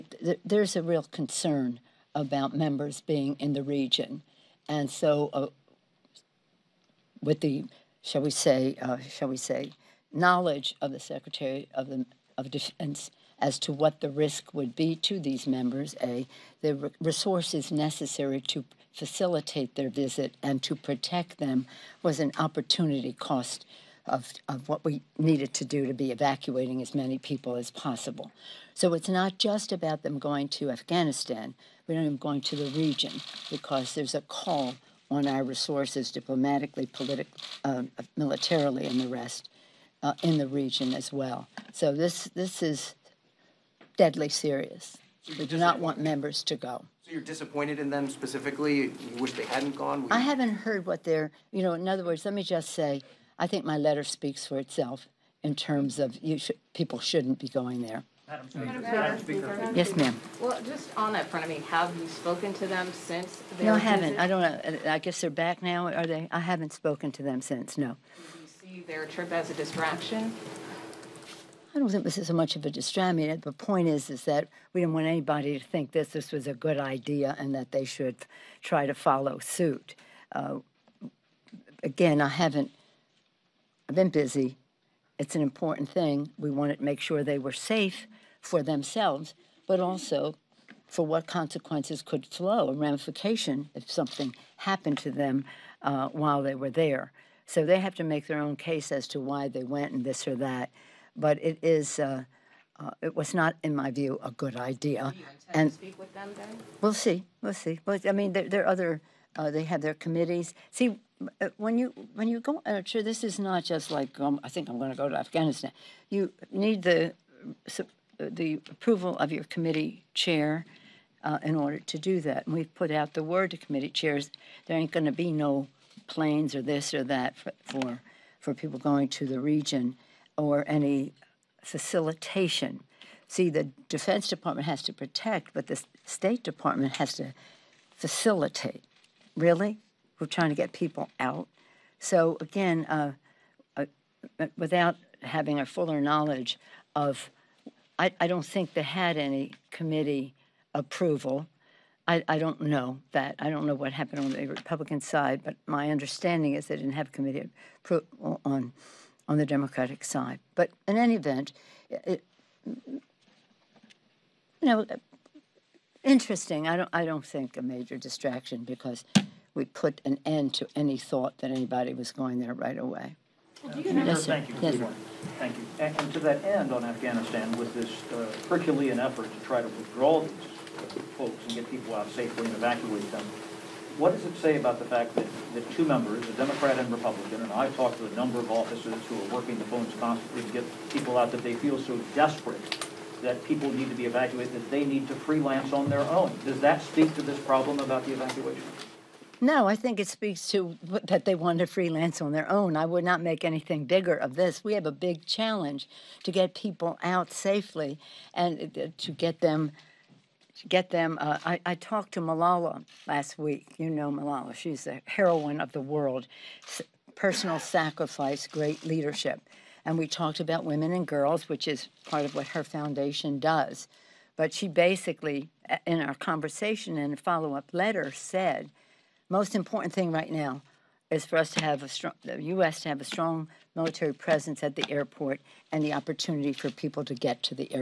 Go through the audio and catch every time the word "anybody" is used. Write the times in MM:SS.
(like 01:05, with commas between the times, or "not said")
01:15, 02:51.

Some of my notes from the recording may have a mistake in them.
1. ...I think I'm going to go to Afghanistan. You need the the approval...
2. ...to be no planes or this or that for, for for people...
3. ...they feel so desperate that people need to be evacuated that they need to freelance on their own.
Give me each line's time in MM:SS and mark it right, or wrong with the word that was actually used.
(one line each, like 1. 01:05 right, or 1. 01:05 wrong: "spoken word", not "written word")
1. 01:54 right
2. 02:05 right
3. 03:11 right.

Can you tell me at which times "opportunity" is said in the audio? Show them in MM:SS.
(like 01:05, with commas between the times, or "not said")
00:22, 03:55.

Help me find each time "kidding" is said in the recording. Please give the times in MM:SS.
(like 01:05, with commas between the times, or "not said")
not said.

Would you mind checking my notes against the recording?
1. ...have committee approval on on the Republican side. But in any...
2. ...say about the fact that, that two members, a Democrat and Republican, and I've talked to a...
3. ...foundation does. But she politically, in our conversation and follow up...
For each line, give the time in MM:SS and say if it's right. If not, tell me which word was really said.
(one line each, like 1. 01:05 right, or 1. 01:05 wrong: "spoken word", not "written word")
1. 02:36 wrong: "Democratic", not "Republican"
2. 03:04 right
3. 03:42 wrong: "basically", not "politically".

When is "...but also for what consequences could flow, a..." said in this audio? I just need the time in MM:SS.
01:29.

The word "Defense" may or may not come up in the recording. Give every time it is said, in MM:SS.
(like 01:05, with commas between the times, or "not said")
00:12, 02:13.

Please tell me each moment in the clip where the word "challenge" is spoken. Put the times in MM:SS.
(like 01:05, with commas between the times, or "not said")
03:25.